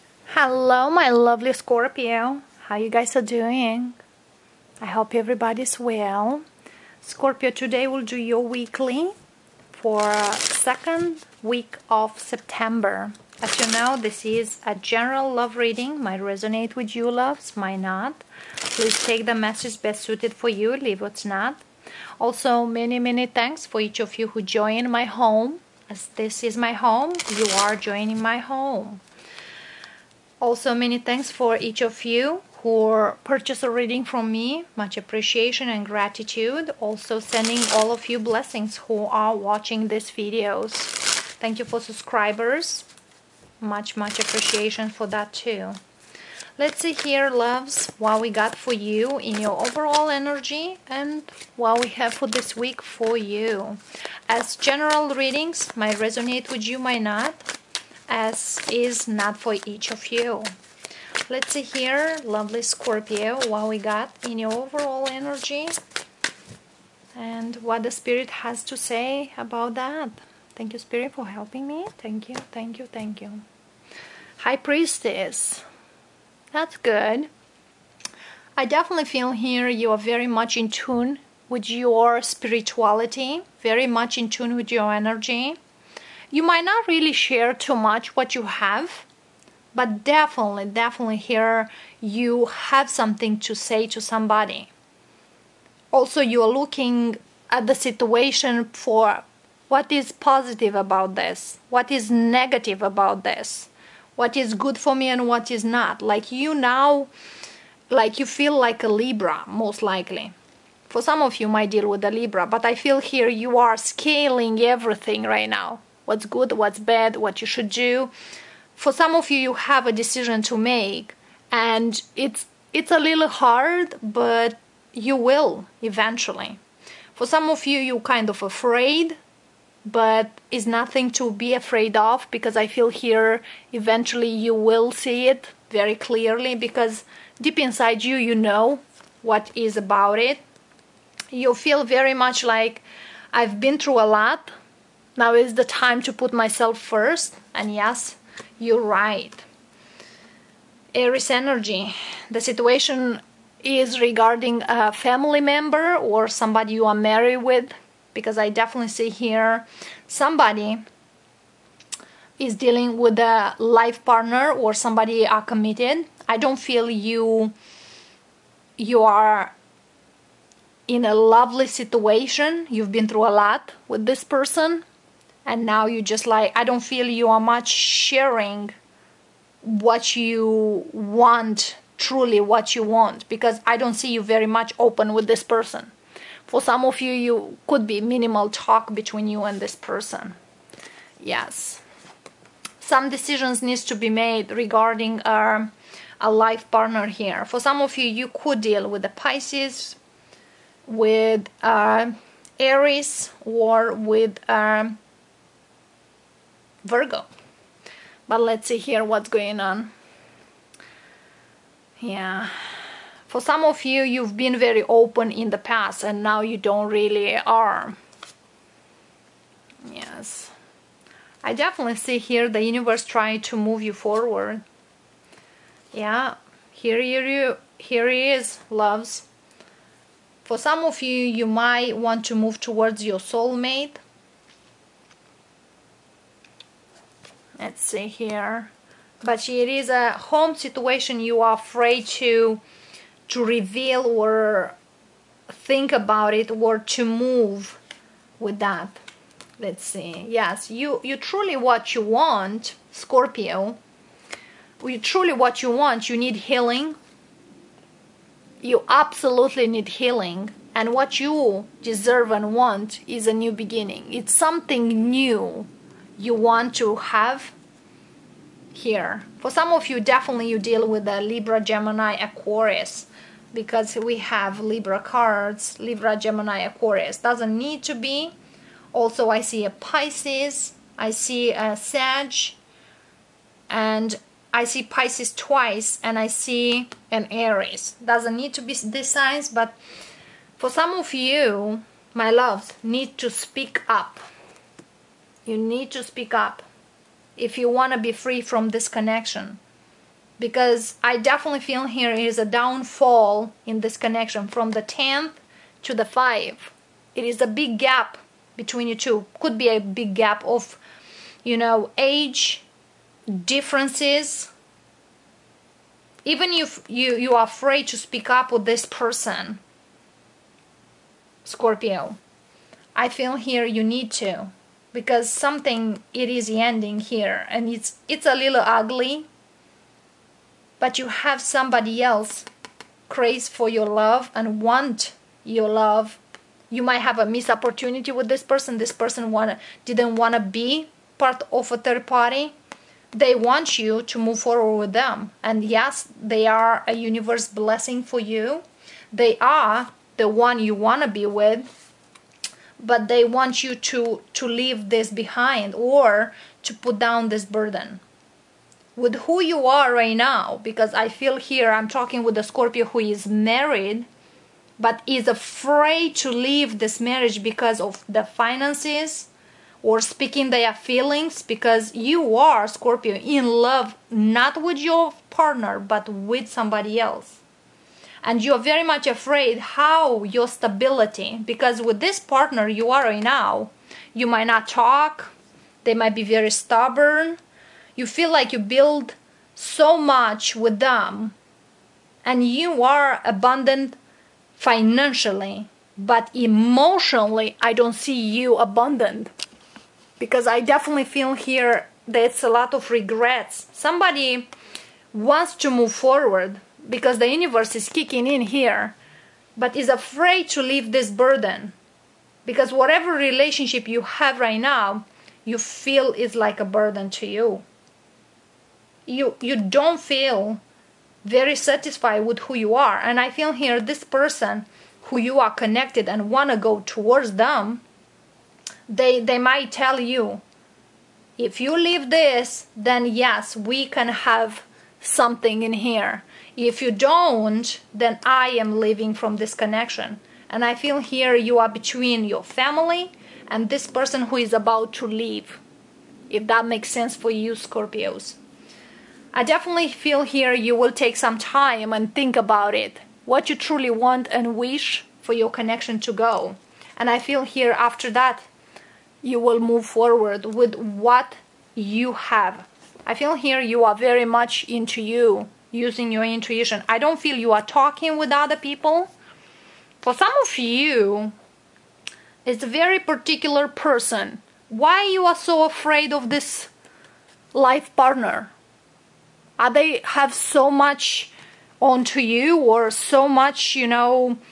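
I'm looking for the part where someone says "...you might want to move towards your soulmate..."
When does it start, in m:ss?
3:51.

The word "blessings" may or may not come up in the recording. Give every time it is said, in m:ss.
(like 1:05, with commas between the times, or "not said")
0:38, 5:47.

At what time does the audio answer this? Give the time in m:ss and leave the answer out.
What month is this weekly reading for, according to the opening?
0:12.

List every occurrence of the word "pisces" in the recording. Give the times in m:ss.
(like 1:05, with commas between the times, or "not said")
3:19, 4:39, 4:44.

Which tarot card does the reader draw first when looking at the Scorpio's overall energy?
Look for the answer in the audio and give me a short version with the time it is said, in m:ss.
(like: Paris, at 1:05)
High Priestess, at 1:14.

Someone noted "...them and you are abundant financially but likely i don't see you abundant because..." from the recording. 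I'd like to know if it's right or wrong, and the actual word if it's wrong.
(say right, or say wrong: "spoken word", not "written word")
wrong: "emotionally", not "likely".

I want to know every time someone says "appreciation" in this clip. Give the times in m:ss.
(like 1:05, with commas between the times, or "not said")
0:34, 0:44.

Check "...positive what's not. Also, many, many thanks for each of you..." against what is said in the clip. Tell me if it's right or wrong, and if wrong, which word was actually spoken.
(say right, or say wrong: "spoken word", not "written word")
wrong: "leave", not "positive".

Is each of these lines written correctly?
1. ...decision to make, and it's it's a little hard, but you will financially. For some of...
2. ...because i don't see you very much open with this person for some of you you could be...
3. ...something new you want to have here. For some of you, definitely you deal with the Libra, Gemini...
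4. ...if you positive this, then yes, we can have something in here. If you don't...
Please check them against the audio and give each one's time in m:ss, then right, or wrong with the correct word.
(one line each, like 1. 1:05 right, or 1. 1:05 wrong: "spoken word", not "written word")
1. 1:59 wrong: "eventually", not "financially"
2. 3:03 right
3. 4:24 right
4. 7:11 wrong: "leave", not "positive".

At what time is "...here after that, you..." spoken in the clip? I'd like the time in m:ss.
7:37.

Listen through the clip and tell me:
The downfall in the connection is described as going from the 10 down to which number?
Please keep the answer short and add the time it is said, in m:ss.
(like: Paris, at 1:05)
5, at 5:05.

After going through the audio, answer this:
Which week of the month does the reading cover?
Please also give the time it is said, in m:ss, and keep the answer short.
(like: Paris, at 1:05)
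Second week, at 0:10.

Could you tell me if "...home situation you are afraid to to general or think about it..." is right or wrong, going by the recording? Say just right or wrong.
wrong.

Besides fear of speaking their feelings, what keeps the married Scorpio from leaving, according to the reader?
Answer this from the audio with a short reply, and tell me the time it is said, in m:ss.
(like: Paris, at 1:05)
Finances, at 6:08.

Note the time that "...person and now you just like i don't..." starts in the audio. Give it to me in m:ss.
2:54.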